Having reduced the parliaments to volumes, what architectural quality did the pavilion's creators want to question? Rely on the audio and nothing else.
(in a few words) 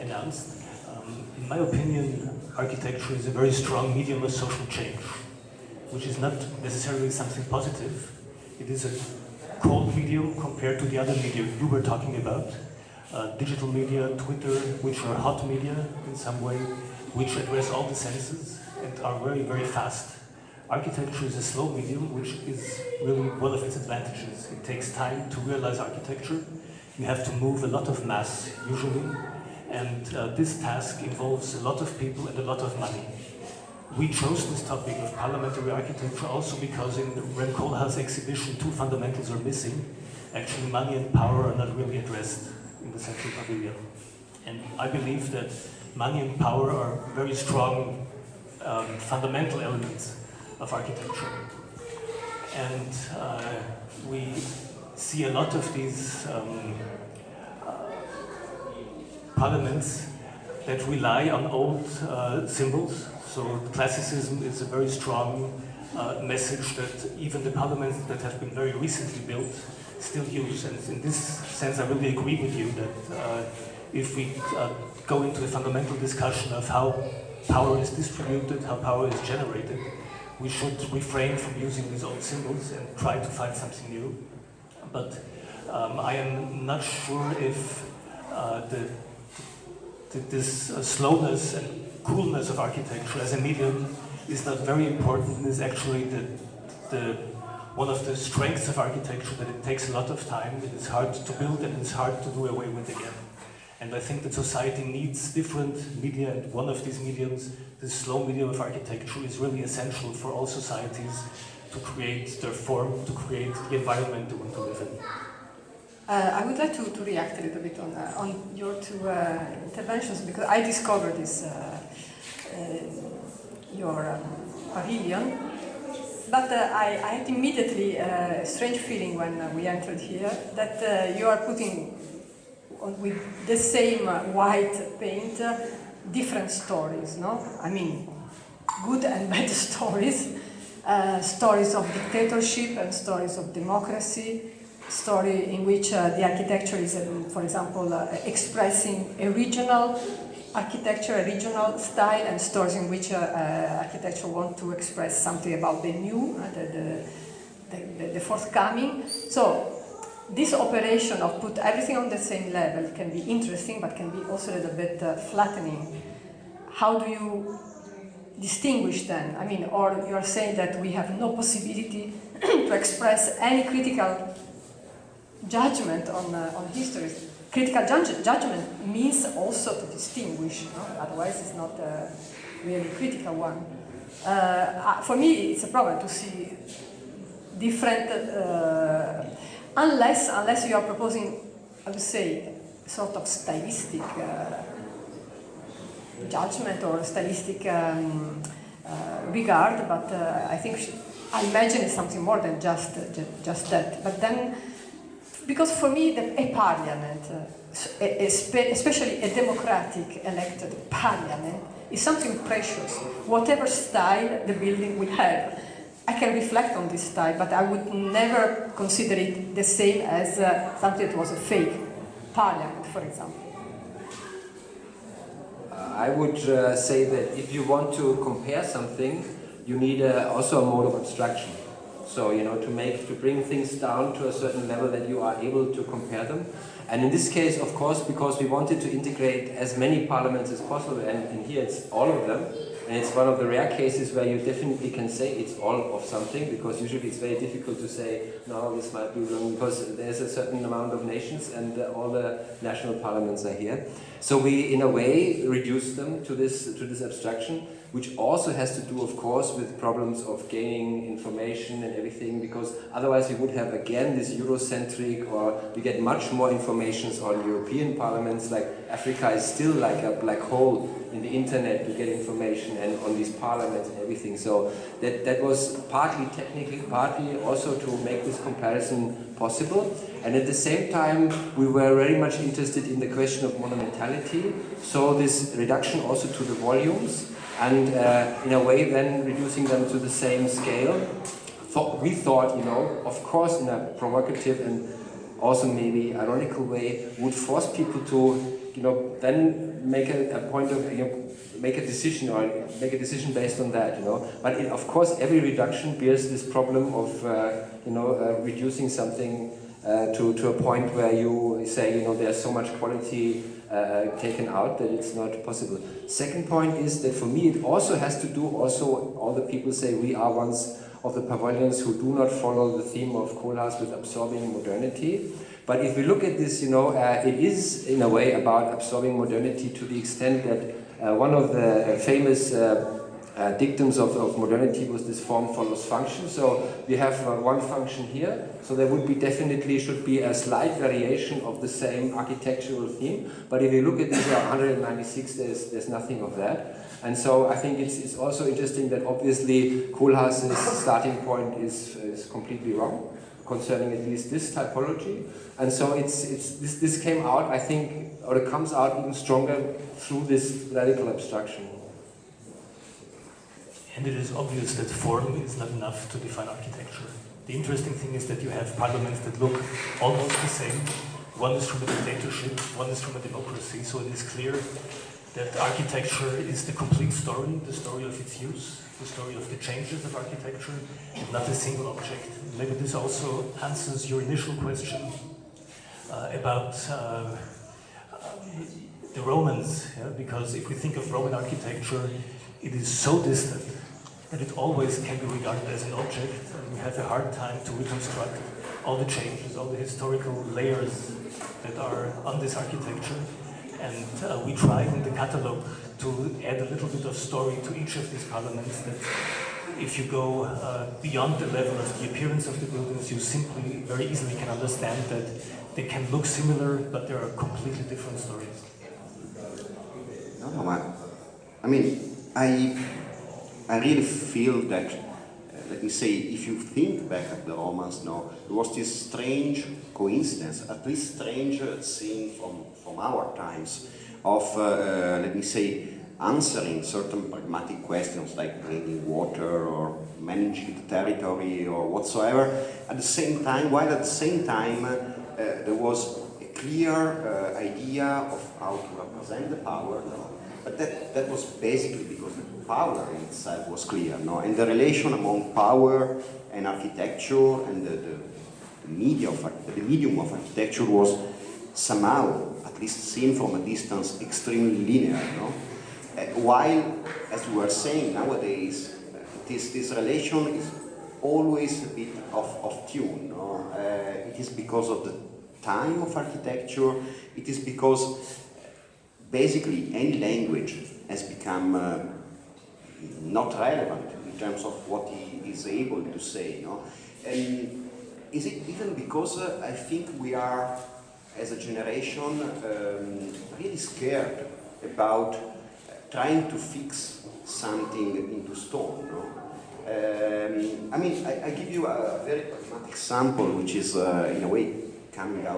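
Monumentality.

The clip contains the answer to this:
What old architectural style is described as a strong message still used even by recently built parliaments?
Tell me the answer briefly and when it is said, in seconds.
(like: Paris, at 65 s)
Classicism, at 63 s.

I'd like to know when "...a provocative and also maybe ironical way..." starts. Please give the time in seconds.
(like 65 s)
293 s.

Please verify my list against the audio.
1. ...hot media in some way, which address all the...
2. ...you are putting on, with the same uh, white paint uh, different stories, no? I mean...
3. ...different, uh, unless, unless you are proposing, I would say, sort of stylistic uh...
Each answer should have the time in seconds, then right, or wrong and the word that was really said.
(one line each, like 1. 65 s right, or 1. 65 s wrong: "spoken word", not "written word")
1. 15 s right
2. 131 s right
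3. 187 s right.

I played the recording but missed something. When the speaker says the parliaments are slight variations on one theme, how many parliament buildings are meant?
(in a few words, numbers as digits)
196.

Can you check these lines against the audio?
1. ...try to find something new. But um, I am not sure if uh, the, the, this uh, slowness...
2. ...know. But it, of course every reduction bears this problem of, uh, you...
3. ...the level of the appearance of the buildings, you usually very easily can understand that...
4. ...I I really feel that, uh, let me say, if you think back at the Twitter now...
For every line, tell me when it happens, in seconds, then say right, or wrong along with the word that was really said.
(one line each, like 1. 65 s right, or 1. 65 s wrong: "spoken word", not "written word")
1. 82 s right
2. 304 s right
3. 411 s wrong: "simply", not "usually"
4. 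422 s wrong: "Romans", not "Twitter".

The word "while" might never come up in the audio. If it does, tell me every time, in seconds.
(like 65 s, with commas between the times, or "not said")
443 s, 466 s.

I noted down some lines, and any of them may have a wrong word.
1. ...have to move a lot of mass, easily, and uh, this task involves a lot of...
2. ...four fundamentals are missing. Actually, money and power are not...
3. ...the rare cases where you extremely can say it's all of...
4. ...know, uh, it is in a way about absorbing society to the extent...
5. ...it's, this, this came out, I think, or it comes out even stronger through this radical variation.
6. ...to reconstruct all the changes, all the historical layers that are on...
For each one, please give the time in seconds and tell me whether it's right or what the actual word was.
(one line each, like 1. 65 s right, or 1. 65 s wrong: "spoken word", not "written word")
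1. 27 s wrong: "usually", not "easily"
2. 38 s wrong: "two", not "four"
3. 243 s wrong: "definitely", not "extremely"
4. 326 s wrong: "modernity", not "society"
5. 356 s wrong: "abstraction", not "variation"
6. 397 s right.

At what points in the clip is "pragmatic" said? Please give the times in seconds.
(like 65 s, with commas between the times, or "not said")
437 s, 502 s.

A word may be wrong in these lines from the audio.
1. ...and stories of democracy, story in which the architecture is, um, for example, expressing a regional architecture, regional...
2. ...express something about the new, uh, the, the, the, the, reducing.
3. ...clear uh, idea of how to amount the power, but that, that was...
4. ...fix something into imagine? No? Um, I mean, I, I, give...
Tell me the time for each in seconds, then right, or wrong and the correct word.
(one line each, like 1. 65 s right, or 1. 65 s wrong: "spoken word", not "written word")
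1. 142 s right
2. 154 s wrong: "forthcoming", not "reducing"
3. 446 s wrong: "represent", not "amount"
4. 496 s wrong: "stone", not "imagine".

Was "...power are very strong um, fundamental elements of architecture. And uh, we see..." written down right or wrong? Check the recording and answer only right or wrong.
right.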